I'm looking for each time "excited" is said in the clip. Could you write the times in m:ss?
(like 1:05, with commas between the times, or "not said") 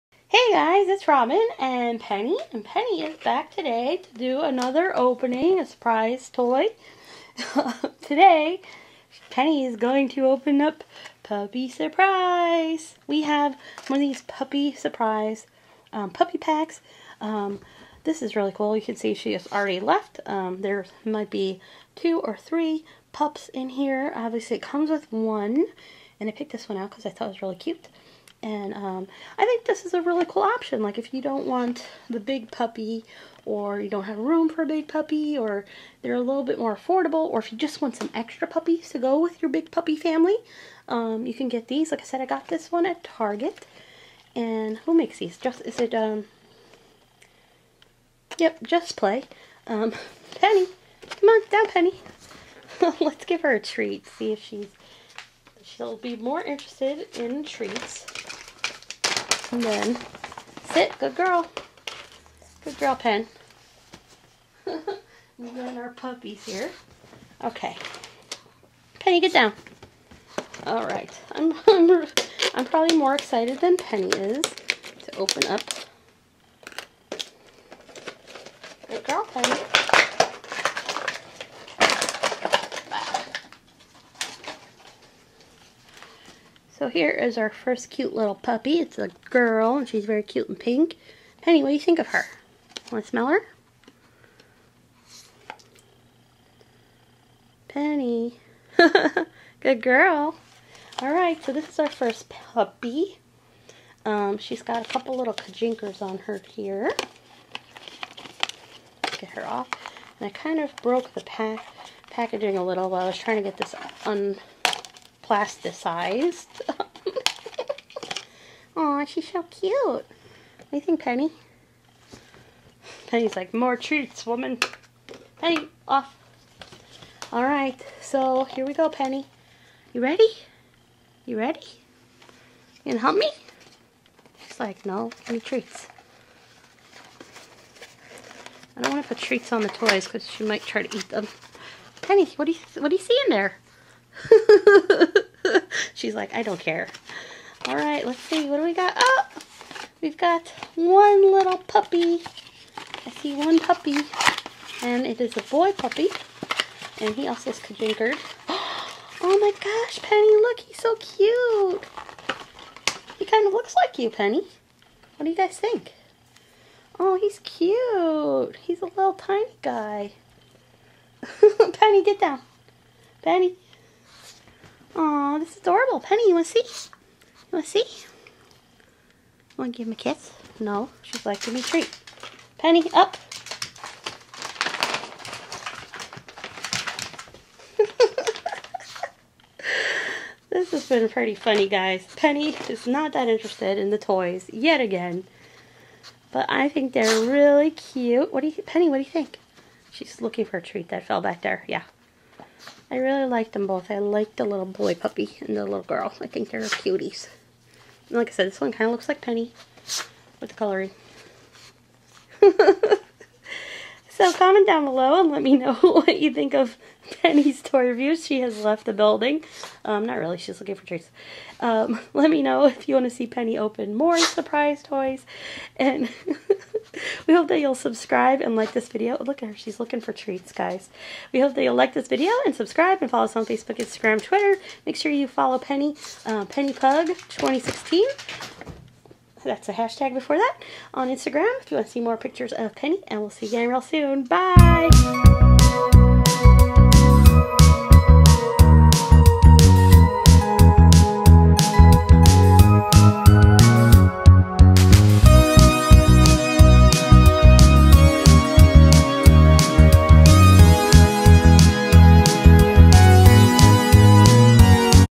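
1:13.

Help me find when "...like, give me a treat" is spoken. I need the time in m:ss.
3:01.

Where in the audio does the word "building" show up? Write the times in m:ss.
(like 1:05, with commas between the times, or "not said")
3:38.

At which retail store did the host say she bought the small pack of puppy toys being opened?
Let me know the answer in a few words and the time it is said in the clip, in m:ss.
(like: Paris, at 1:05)
Target, at 0:43.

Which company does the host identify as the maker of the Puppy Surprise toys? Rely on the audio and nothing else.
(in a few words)
Just Play.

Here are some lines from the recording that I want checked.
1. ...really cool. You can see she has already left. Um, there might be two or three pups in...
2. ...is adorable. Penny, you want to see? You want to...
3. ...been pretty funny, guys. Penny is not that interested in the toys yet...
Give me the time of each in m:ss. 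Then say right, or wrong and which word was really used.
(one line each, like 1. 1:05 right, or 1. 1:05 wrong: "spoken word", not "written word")
1. 0:18 right
2. 2:55 right
3. 3:10 right.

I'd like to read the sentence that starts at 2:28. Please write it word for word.
Oh, we've got one little puppy.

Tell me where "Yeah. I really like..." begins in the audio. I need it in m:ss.
3:21.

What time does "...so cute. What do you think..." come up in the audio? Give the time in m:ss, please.
1:59.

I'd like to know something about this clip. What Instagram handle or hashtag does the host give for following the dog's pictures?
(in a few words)
Penny Pug 2016.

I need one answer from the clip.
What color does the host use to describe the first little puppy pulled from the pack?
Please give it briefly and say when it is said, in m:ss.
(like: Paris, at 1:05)
Pink, at 1:30.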